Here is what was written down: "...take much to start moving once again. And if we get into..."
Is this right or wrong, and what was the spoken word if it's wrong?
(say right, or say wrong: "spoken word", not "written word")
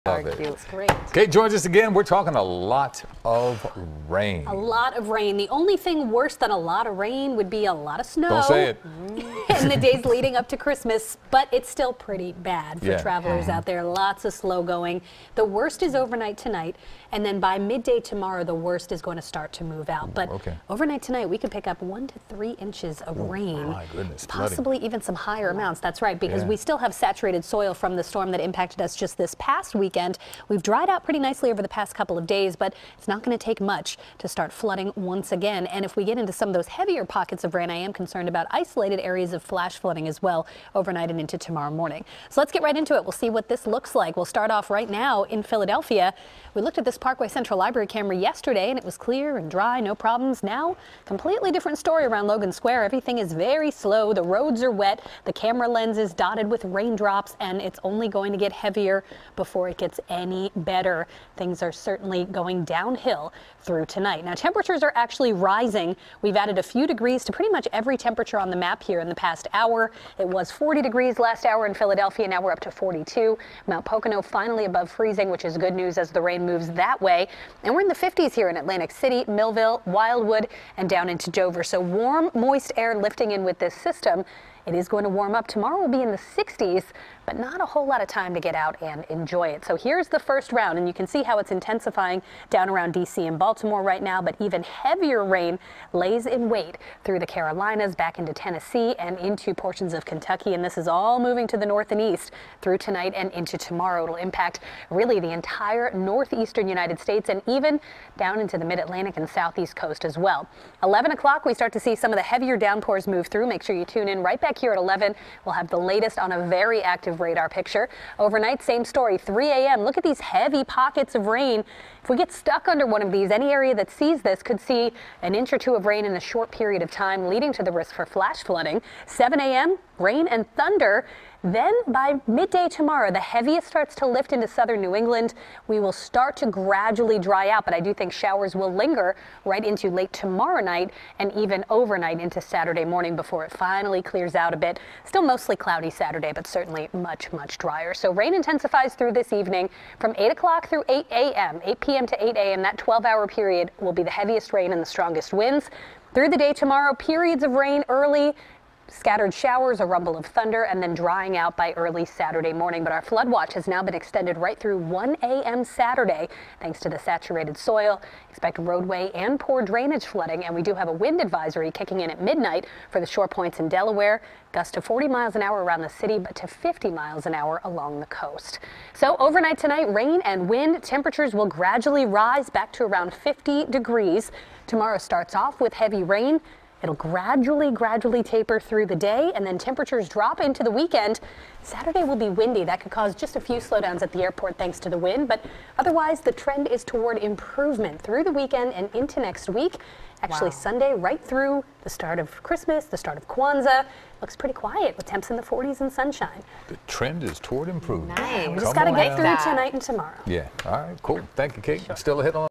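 wrong: "flooding", not "moving".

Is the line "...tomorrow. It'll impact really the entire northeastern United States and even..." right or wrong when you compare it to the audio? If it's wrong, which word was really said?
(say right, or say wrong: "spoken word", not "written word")
right.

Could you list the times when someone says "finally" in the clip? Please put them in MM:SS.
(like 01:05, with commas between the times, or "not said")
01:14, 02:23.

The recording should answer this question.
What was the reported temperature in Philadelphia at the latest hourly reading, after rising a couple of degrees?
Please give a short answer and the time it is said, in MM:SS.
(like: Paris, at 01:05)
42, at 01:12.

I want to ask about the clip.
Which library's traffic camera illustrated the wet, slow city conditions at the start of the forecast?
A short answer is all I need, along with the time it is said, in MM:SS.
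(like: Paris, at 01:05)
Parkway Central Library, at 00:46.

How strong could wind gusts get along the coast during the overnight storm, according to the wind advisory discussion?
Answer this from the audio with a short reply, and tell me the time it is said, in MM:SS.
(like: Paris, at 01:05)
50 miles an hour, at 02:56.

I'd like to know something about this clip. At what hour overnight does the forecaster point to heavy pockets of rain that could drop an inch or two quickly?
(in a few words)
3 a.m.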